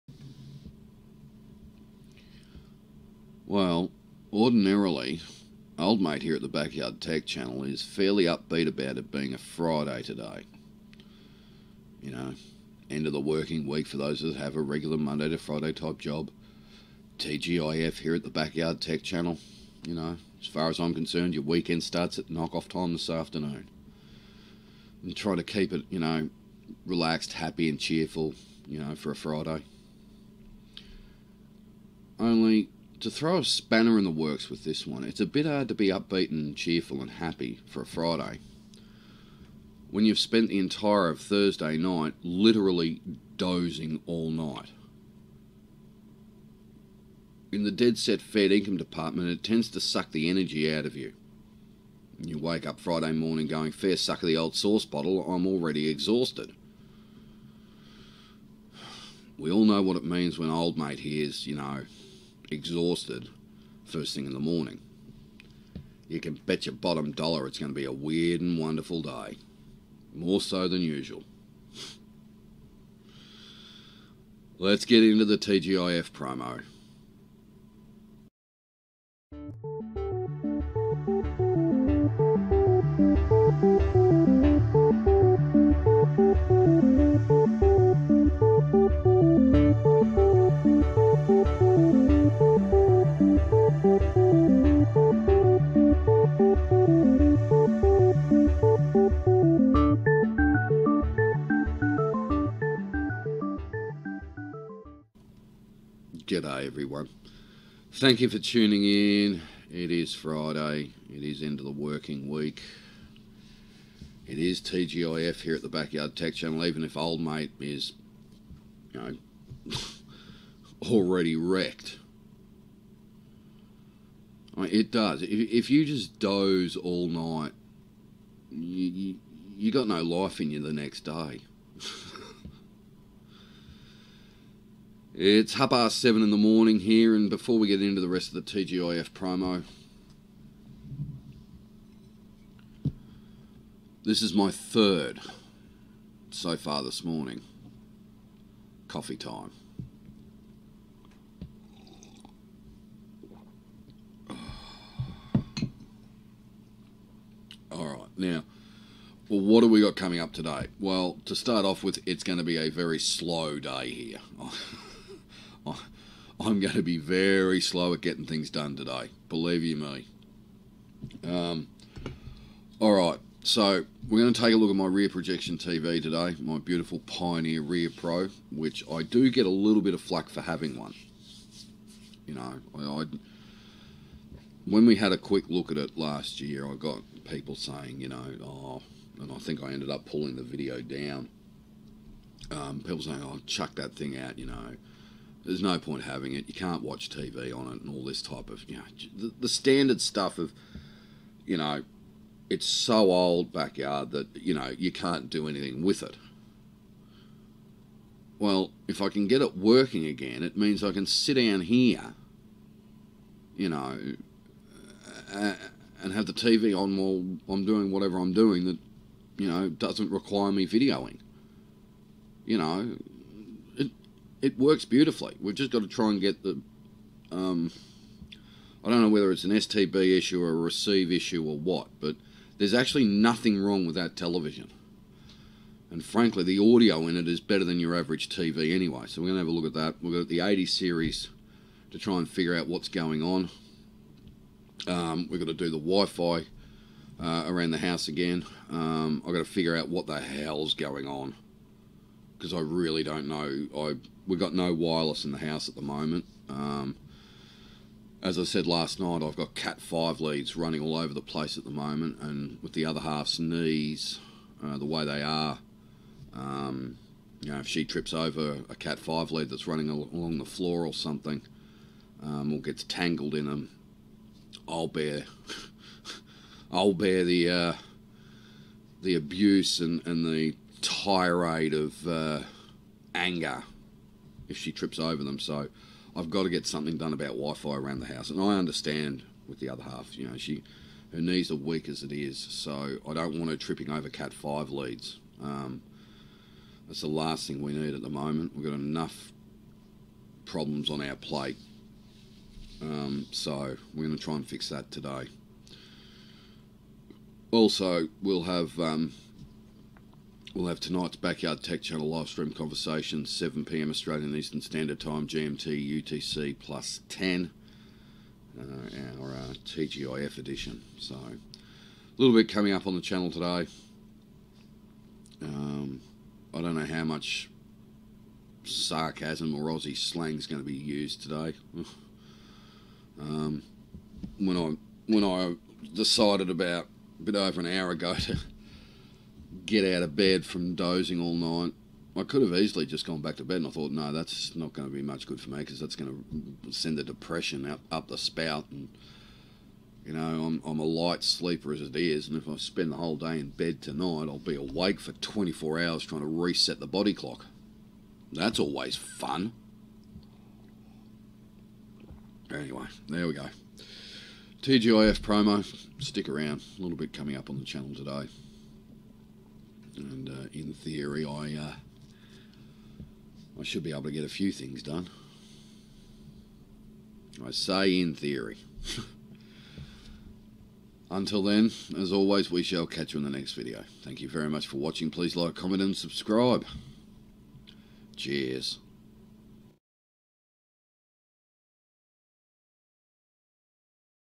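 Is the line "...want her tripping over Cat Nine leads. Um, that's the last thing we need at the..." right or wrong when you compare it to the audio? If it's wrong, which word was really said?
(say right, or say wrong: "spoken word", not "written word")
wrong: "Five", not "Nine".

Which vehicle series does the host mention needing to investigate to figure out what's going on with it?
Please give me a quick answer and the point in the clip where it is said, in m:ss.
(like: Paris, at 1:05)
80 series, at 4:00.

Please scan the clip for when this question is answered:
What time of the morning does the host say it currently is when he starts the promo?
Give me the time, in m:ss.
2:15.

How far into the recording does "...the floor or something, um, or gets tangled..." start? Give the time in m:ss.
4:30.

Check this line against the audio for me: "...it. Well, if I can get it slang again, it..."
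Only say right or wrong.
wrong.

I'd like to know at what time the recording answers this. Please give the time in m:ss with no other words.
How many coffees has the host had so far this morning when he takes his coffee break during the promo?
2:24.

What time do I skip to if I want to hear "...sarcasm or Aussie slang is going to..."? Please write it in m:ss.
5:28.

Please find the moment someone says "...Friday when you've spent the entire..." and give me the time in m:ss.
0:37.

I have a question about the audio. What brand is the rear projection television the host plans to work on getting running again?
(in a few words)
Pioneer.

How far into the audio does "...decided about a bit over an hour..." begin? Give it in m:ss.
5:35.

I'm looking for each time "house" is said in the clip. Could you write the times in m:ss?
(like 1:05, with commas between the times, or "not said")
4:07, 4:15, 4:48.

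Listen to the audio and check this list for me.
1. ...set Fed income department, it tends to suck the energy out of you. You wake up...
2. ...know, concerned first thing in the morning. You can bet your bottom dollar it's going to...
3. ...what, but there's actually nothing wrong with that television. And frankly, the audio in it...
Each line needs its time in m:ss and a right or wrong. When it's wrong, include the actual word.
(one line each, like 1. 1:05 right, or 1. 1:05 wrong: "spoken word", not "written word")
1. 0:47 right
2. 1:01 wrong: "exhausted", not "concerned"
3. 3:51 right.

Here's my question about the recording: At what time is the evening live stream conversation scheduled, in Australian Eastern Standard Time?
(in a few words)
7 pm.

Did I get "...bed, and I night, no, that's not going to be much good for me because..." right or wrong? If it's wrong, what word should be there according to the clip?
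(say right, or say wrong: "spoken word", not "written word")
wrong: "thought", not "night".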